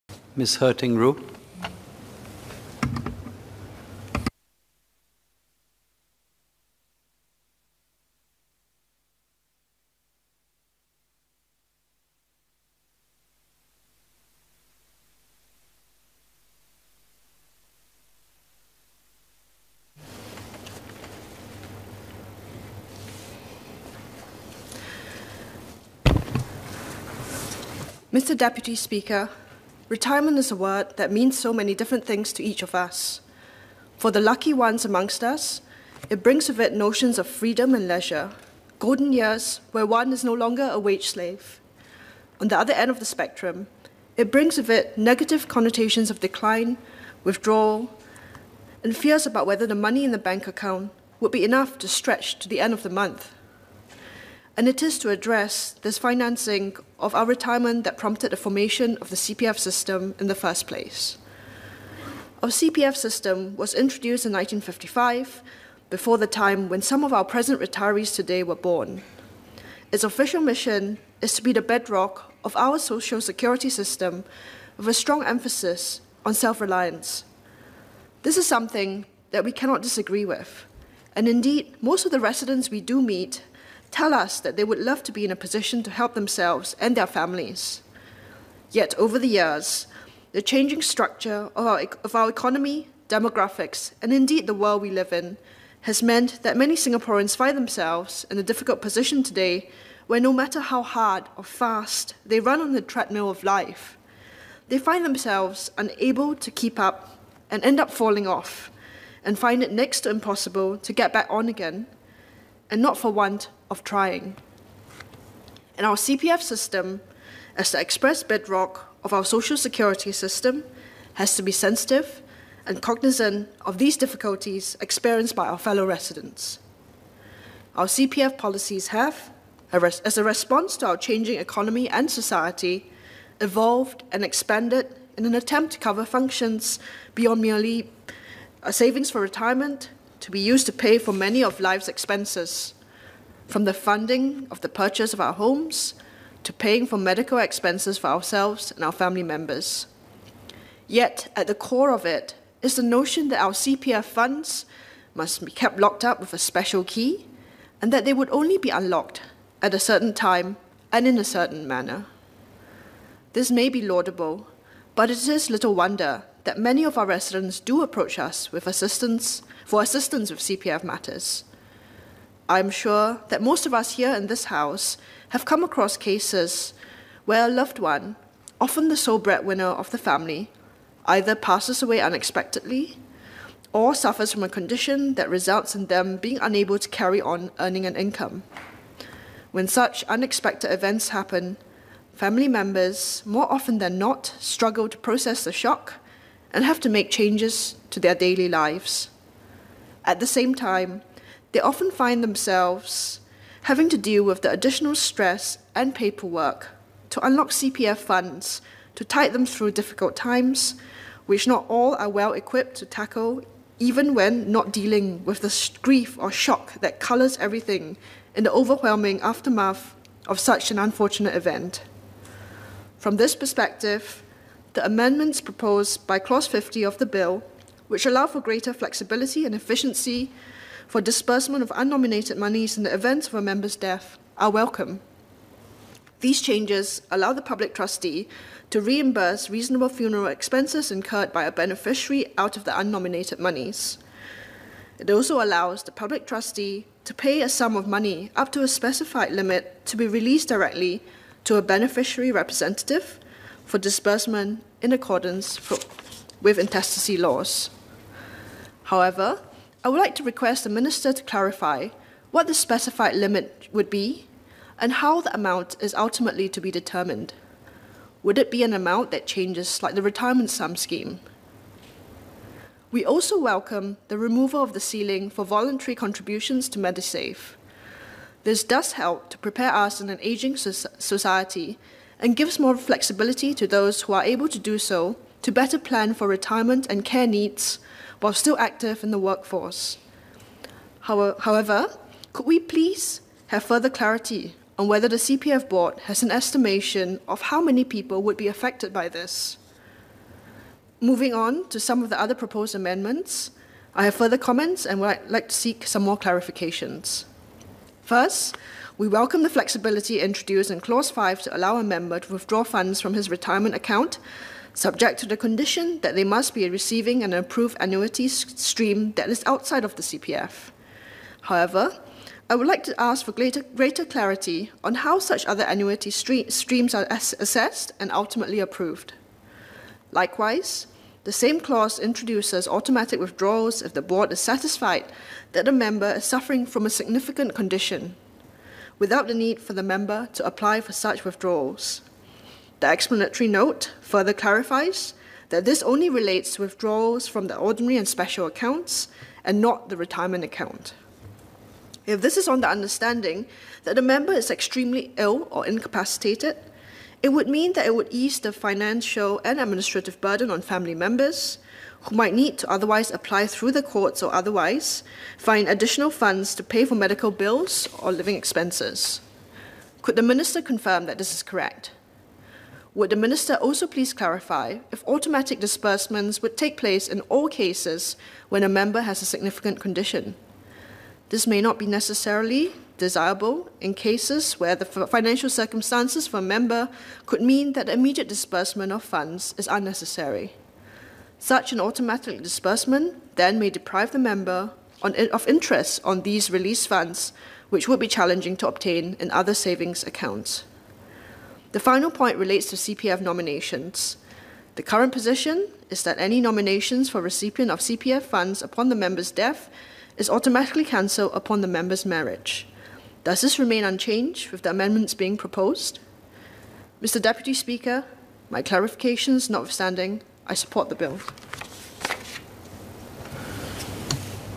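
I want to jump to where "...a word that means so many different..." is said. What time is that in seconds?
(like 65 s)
30 s.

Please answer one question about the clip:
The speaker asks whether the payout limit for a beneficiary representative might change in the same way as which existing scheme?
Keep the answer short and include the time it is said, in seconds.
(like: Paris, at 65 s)
Retirement sum scheme, at 270 s.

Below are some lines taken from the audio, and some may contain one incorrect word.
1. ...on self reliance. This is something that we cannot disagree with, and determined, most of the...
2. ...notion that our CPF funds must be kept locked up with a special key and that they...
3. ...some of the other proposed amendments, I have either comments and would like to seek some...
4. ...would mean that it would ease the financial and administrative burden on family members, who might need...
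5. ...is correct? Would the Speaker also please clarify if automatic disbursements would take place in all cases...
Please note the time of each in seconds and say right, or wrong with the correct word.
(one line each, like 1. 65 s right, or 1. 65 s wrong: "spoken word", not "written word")
1. 76 s wrong: "indeed", not "determined"
2. 152 s right
3. 301 s wrong: "further", not "either"
4. 357 s right
5. 371 s wrong: "Minister", not "Speaker".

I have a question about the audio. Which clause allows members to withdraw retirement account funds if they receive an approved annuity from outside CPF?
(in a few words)
Clause 5.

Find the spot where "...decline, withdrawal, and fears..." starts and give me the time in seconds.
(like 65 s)
46 s.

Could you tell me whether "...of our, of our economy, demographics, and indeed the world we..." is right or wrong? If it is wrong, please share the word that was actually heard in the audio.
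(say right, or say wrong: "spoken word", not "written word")
right.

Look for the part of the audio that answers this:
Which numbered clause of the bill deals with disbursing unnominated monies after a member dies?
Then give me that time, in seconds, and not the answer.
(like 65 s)
226 s.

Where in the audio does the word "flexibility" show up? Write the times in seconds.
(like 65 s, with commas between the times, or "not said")
228 s, 282 s, 309 s.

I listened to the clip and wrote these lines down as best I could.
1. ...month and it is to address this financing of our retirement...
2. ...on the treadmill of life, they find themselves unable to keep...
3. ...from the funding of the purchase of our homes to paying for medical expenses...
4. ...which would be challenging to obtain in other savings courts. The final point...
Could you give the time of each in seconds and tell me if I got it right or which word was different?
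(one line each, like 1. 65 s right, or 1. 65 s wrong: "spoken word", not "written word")
1. 52 s right
2. 102 s right
3. 143 s right
4. 397 s wrong: "accounts", not "courts".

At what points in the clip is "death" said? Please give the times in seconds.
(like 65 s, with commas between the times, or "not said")
233 s, 409 s.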